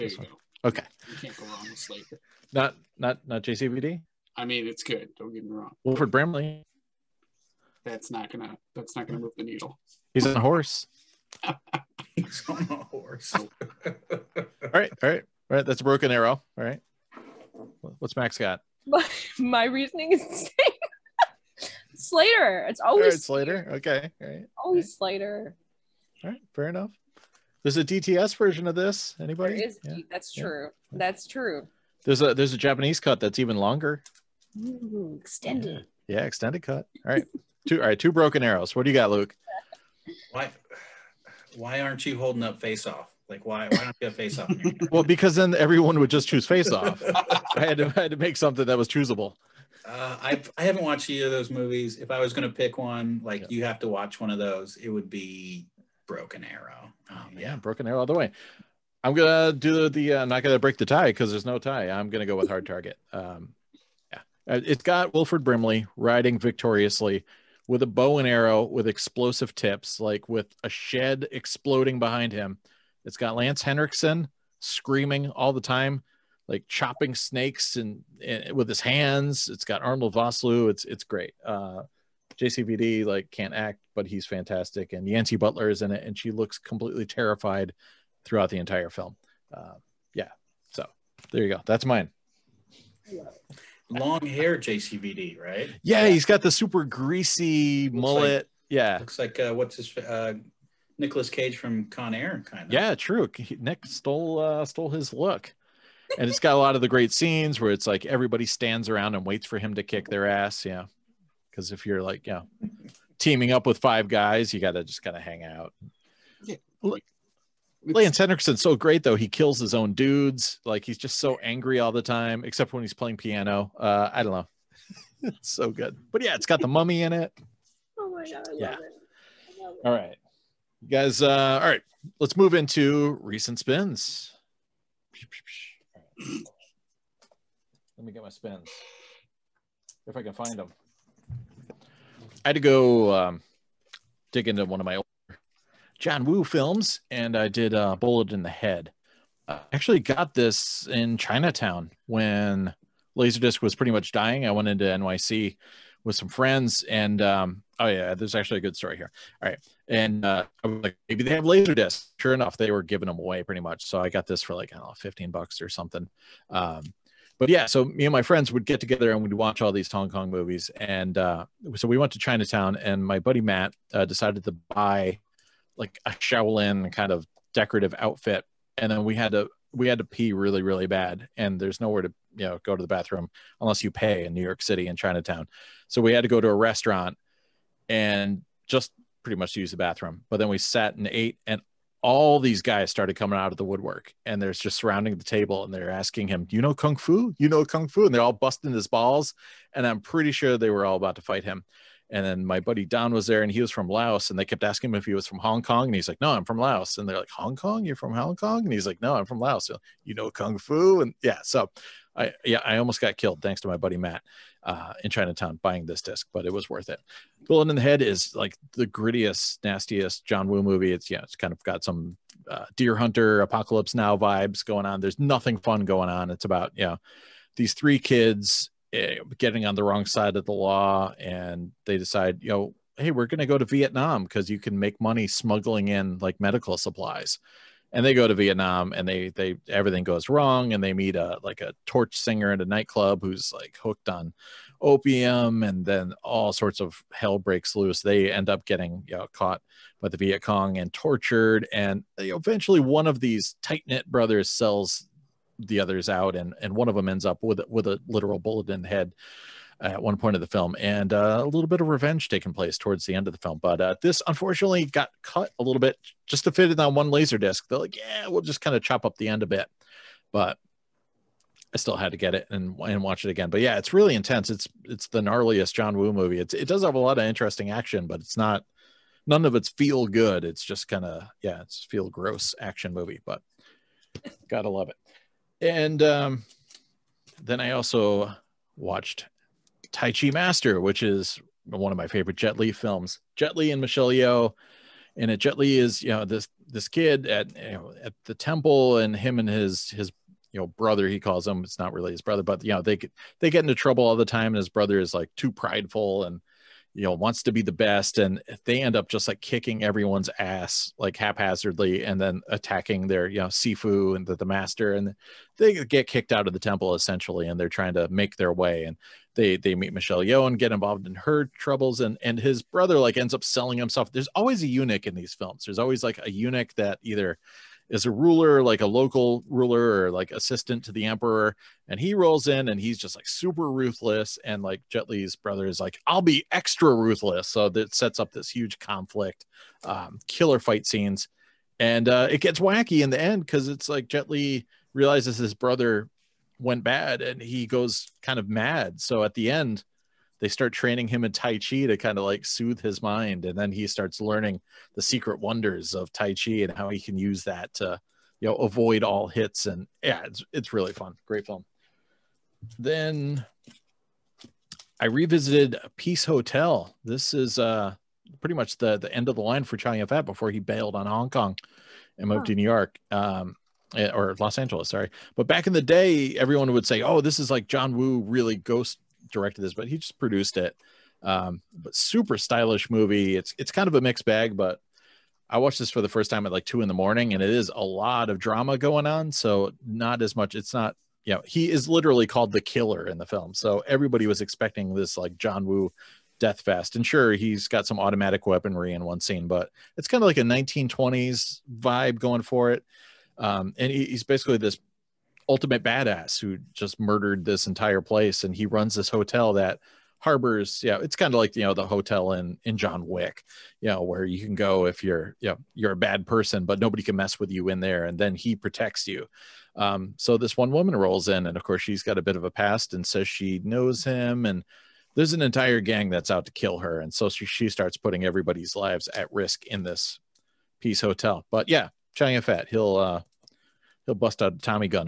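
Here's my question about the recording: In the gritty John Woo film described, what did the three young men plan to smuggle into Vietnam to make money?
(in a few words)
medical supplies.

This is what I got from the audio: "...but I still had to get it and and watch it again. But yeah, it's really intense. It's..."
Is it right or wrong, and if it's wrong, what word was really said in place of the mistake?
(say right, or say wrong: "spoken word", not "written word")
right.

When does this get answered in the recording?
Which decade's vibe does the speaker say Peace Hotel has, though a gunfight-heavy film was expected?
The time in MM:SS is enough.
06:40.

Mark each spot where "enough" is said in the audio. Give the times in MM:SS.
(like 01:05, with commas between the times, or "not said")
00:26, 02:42.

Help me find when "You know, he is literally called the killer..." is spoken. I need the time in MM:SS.
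06:31.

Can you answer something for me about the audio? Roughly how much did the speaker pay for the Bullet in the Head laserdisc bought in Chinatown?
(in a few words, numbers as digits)
15 bucks.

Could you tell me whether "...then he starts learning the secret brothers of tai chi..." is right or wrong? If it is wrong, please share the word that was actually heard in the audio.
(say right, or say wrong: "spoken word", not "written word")
wrong: "wonders", not "brothers".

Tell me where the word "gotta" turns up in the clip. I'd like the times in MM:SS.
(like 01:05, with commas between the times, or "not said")
01:54, 04:44.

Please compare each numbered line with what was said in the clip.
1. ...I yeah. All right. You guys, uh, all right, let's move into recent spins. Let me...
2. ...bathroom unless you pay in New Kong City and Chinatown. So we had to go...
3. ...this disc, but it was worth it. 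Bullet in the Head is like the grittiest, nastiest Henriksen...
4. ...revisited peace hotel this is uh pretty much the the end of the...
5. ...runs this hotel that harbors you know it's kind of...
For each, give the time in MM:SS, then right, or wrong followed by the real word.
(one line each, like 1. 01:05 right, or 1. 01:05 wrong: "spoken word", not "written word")
1. 02:08 right
2. 03:02 wrong: "York", not "Kong"
3. 03:35 wrong: "John", not "Henriksen"
4. 06:05 right
5. 06:48 right.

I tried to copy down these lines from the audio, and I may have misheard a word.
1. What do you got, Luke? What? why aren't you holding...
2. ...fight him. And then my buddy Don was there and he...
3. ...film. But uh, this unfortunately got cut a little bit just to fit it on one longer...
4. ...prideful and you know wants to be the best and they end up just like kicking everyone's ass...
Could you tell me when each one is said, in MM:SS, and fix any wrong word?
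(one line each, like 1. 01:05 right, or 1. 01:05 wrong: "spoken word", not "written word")
1. 00:38 right
2. 03:21 right
3. 04:23 wrong: "laser", not "longer"
4. 05:05 right.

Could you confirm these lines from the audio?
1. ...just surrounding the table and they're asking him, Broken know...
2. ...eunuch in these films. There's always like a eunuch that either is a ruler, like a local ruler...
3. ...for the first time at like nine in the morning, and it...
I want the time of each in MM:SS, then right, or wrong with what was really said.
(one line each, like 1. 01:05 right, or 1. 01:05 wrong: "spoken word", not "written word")
1. 03:14 wrong: "You", not "Broken"
2. 05:24 right
3. 06:25 wrong: "two", not "nine".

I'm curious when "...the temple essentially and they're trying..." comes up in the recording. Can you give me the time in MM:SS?
05:16.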